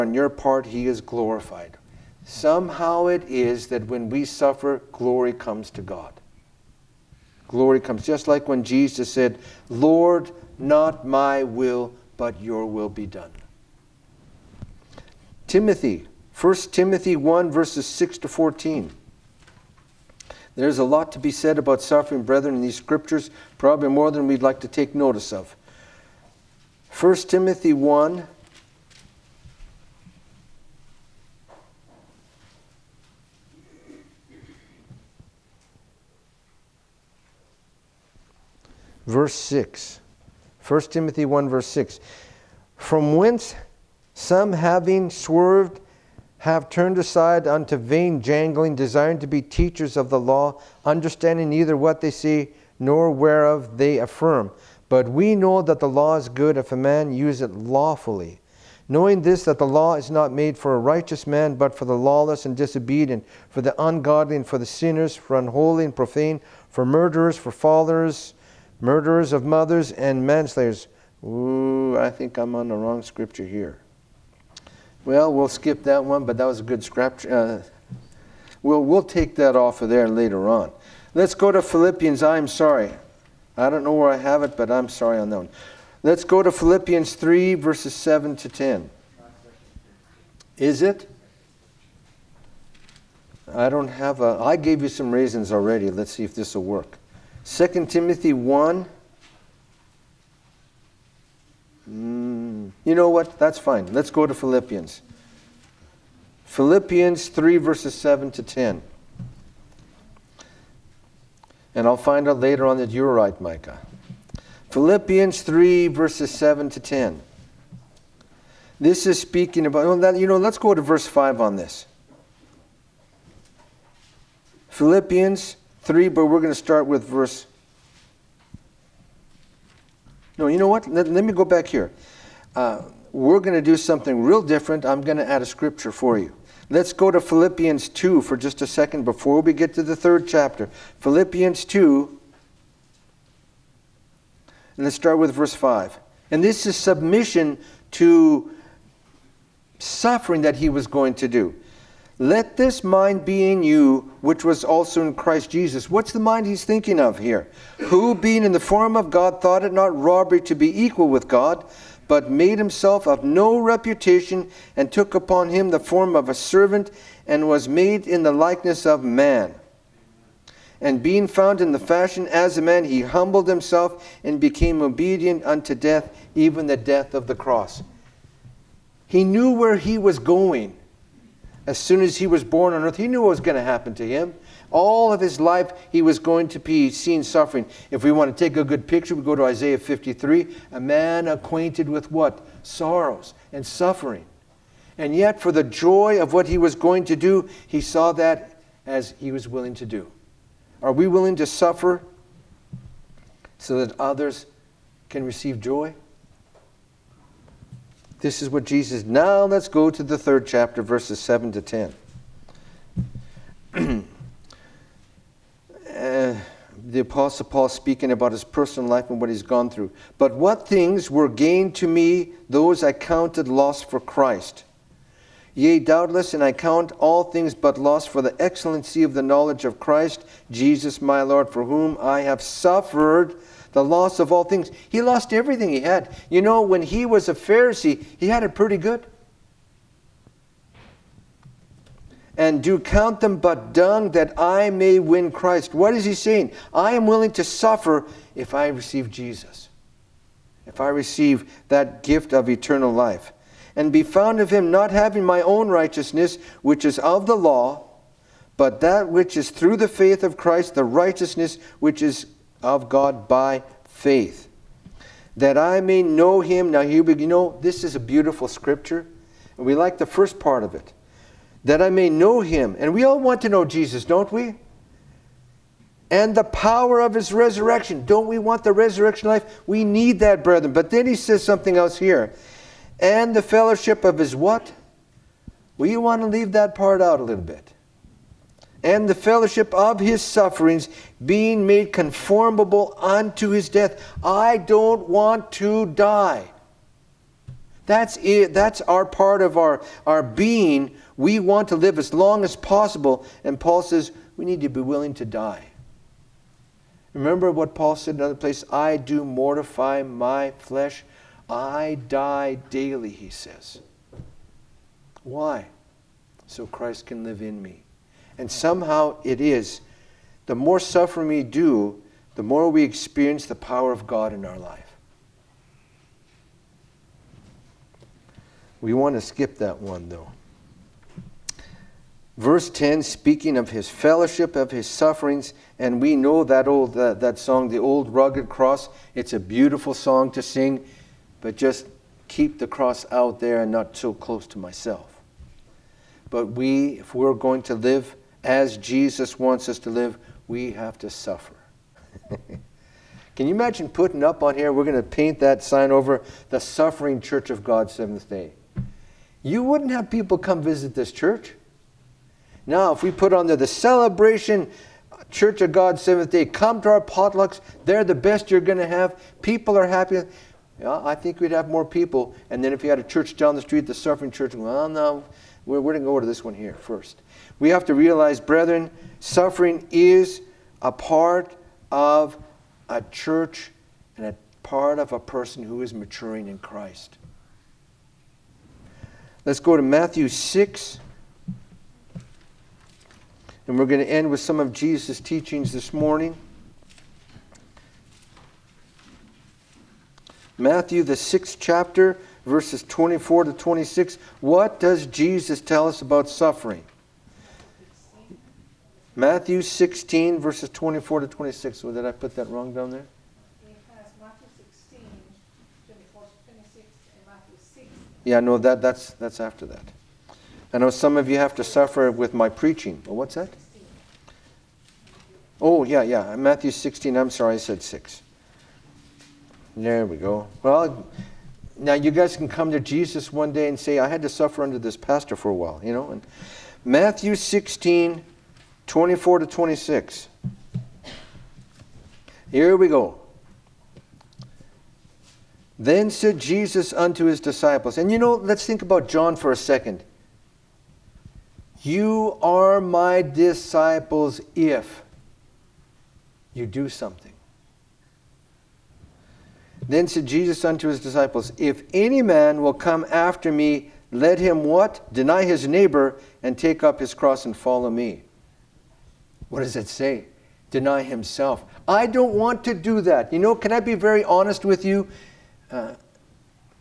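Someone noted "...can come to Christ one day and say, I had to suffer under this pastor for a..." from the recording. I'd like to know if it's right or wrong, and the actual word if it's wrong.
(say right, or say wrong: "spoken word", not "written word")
wrong: "Jesus", not "Christ".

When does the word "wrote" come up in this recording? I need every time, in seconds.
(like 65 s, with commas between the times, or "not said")
not said.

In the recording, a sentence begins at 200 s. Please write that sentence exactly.
Are we willing to suffer so that others can receive joy?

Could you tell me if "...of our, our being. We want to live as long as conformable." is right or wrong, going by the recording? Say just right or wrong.
wrong.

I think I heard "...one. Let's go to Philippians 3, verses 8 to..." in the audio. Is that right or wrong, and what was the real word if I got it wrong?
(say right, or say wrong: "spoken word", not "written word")
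wrong: "7", not "8".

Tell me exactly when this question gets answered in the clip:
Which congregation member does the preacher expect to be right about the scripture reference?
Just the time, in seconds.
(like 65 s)
113 s.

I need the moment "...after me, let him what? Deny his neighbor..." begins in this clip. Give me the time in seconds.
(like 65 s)
463 s.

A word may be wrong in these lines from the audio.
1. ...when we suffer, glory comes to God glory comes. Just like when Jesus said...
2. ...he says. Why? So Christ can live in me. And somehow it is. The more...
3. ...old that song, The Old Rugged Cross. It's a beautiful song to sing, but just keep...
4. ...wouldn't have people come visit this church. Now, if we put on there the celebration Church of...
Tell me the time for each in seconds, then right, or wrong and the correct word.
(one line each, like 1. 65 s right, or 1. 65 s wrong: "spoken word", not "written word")
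1. 3 s right
2. 313 s right
3. 336 s right
4. 359 s right.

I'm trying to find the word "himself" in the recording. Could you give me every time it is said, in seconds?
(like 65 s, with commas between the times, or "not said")
162 s, 173 s, 471 s.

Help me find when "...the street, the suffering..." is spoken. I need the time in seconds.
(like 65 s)
373 s.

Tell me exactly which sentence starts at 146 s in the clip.
And this is submission to suffering that he was going to do.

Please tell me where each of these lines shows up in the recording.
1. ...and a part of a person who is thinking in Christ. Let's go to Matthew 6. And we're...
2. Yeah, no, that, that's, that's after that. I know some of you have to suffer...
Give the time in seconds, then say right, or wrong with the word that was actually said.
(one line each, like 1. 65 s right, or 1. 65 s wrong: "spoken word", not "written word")
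1. 384 s wrong: "maturing", not "thinking"
2. 418 s right.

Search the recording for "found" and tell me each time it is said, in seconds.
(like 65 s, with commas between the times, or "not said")
171 s, 254 s.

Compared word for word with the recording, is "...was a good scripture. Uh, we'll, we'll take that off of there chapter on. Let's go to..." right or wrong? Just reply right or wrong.
wrong.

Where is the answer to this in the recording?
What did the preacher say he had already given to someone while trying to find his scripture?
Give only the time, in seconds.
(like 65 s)
95 s.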